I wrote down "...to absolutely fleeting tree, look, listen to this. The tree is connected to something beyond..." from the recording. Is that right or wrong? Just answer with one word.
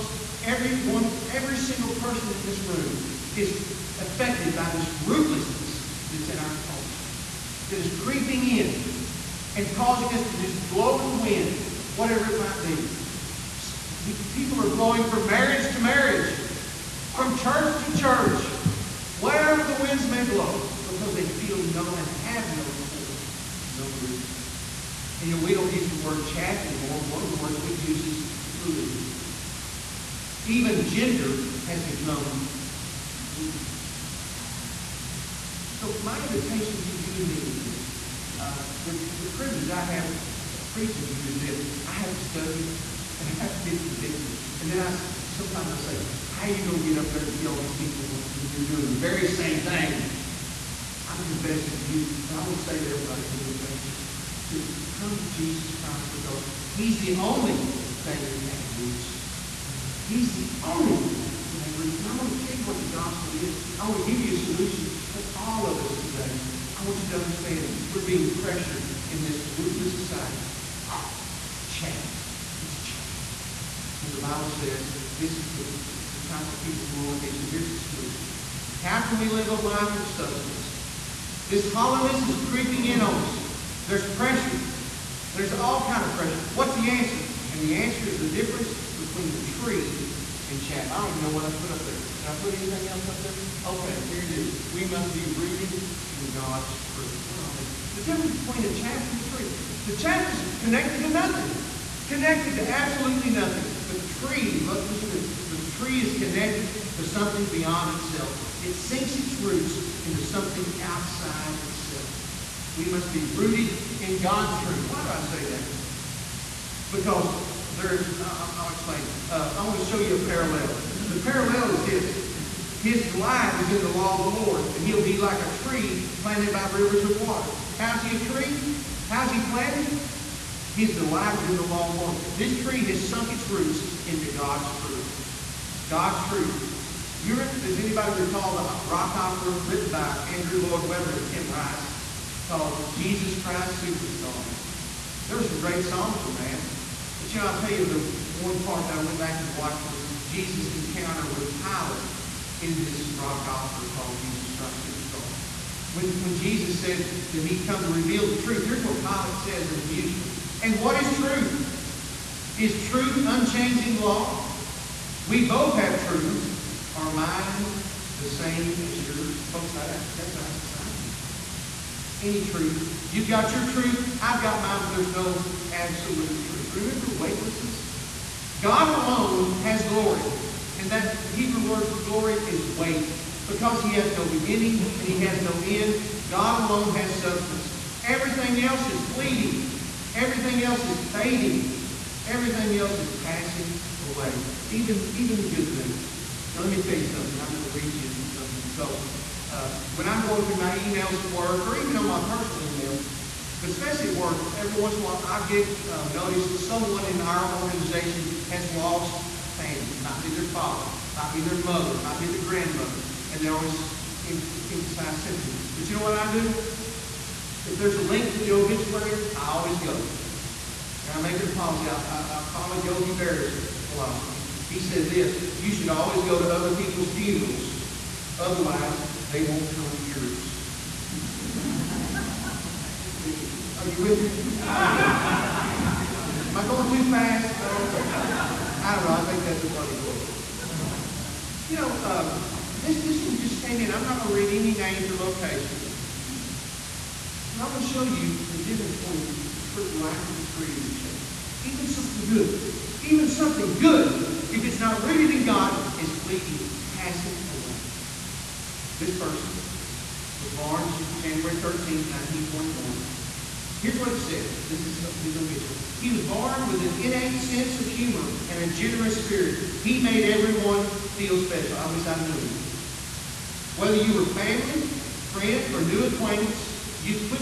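wrong.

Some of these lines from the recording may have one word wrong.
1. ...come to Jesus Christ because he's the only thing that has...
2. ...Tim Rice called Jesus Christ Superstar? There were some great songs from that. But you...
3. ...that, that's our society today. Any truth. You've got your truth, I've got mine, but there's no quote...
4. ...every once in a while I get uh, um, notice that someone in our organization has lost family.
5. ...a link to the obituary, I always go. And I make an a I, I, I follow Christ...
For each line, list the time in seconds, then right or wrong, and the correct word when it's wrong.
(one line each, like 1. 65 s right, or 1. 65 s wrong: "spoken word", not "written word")
1. 54 s right
2. 141 s right
3. 169 s wrong: "absolute", not "quote"
4. 204 s right
5. 217 s wrong: "Yogi", not "Christ".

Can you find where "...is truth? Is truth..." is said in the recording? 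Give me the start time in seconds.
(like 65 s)
161 s.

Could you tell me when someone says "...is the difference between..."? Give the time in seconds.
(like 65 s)
88 s.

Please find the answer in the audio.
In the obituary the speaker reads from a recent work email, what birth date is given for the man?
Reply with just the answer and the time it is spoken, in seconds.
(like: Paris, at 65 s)
January 13, 1941, at 261 s.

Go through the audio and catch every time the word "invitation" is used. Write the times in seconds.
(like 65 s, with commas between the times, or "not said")
36 s, 53 s.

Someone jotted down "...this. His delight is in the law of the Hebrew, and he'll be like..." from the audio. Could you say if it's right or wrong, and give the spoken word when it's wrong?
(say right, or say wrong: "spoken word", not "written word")
wrong: "Lord", not "Hebrew".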